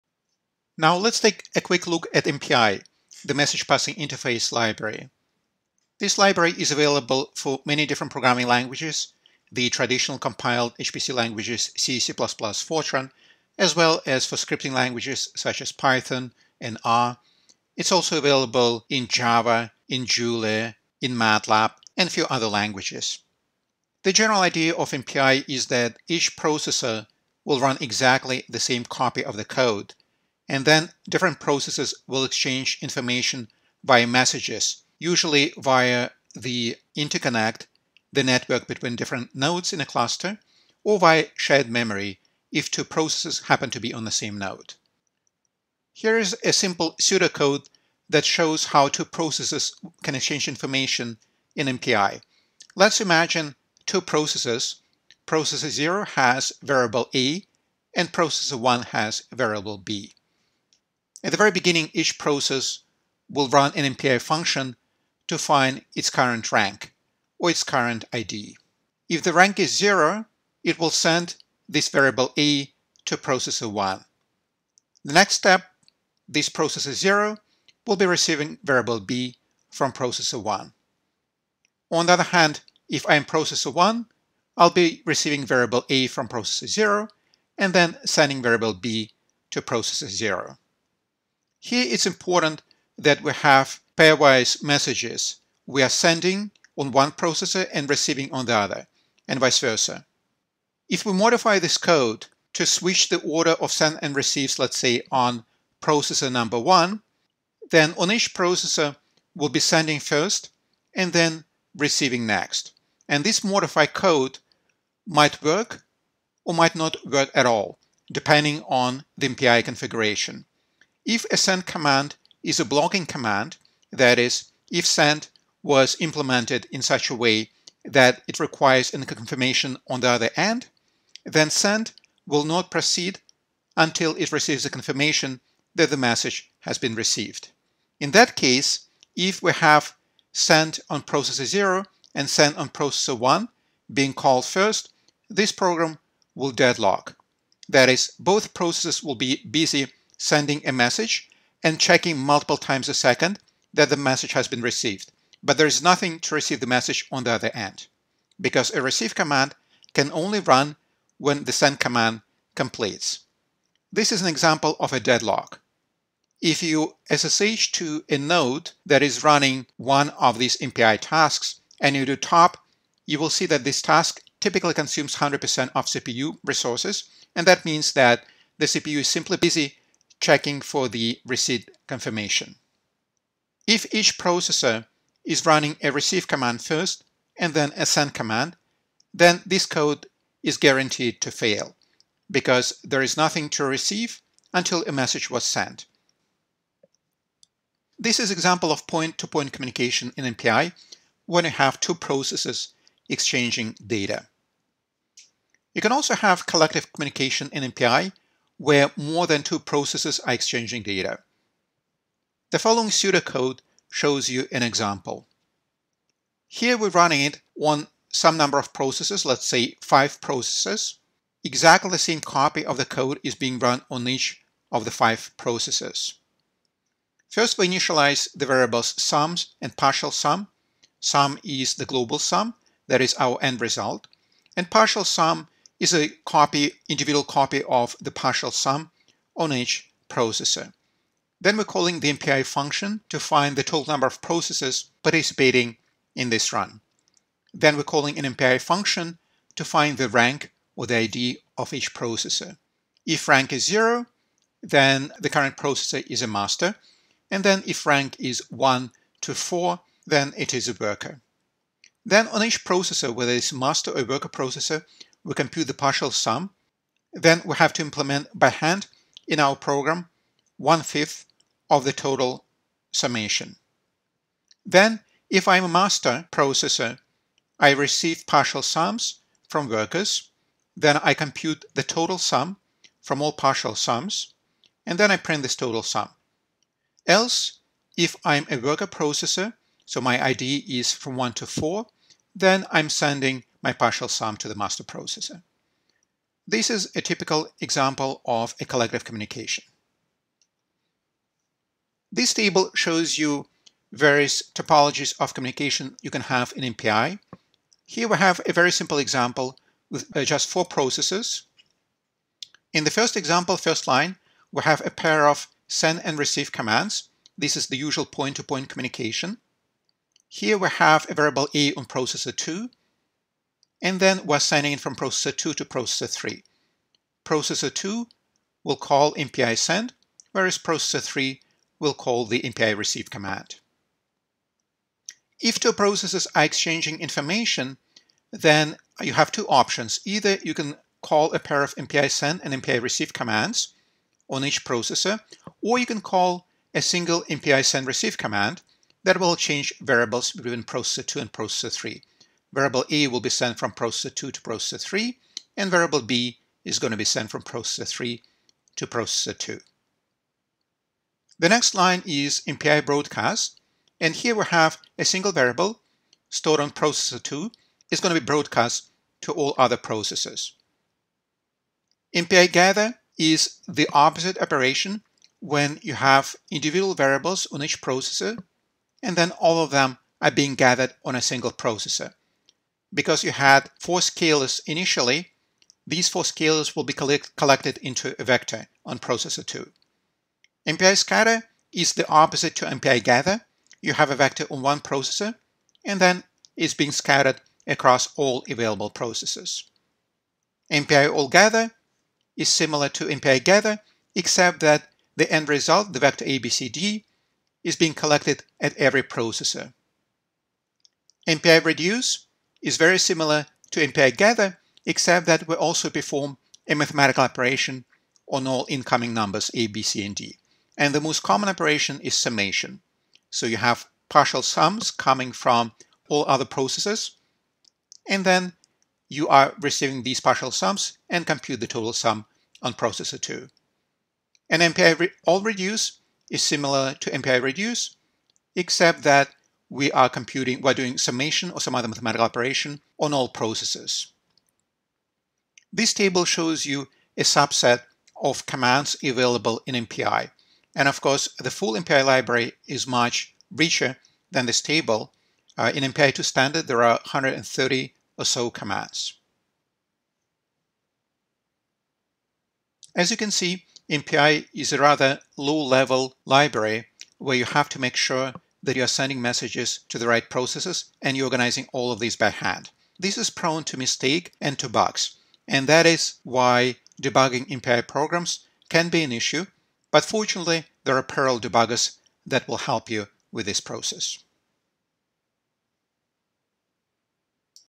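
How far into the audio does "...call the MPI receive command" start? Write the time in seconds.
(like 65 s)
331 s.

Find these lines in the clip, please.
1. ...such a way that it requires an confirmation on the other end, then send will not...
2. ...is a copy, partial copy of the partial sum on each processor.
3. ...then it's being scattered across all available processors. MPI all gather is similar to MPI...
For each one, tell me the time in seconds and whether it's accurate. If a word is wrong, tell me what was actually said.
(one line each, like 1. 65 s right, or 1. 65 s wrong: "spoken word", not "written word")
1. 126 s right
2. 235 s wrong: "individual", not "partial"
3. 395 s right.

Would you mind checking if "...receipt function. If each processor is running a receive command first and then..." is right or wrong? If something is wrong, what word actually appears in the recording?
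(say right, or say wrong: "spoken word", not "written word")
wrong: "confirmation", not "function".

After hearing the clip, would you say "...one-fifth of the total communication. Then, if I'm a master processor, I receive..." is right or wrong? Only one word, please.
wrong.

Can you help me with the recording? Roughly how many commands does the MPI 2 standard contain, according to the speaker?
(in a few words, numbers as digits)
130.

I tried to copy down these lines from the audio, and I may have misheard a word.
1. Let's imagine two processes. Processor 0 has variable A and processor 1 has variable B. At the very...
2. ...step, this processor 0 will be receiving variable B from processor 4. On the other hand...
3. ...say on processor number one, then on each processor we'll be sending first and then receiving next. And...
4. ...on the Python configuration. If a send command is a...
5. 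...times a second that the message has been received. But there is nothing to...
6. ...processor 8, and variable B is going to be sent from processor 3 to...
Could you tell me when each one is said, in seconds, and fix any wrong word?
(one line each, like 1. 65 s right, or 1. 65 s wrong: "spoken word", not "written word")
1. 52 s right
2. 75 s wrong: "1", not "4"
3. 104 s right
4. 118 s wrong: "MPI", not "Python"
5. 152 s right
6. 354 s wrong: "3", not "8".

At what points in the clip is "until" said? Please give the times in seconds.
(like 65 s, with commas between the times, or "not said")
133 s, 194 s.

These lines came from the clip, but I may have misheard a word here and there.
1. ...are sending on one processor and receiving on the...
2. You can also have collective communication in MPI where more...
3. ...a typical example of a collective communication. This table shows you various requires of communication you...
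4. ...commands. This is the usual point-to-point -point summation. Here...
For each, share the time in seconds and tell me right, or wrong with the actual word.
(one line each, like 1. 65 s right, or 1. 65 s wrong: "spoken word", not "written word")
1. 95 s right
2. 205 s right
3. 296 s wrong: "topologies", not "requires"
4. 316 s wrong: "communication", not "summation".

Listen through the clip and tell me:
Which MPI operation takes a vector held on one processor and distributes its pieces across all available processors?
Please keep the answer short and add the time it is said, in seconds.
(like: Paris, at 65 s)
MPI scatter, at 390 s.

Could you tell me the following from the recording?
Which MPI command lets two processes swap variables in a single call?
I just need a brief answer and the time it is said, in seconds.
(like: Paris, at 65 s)
MPI send receive, at 347 s.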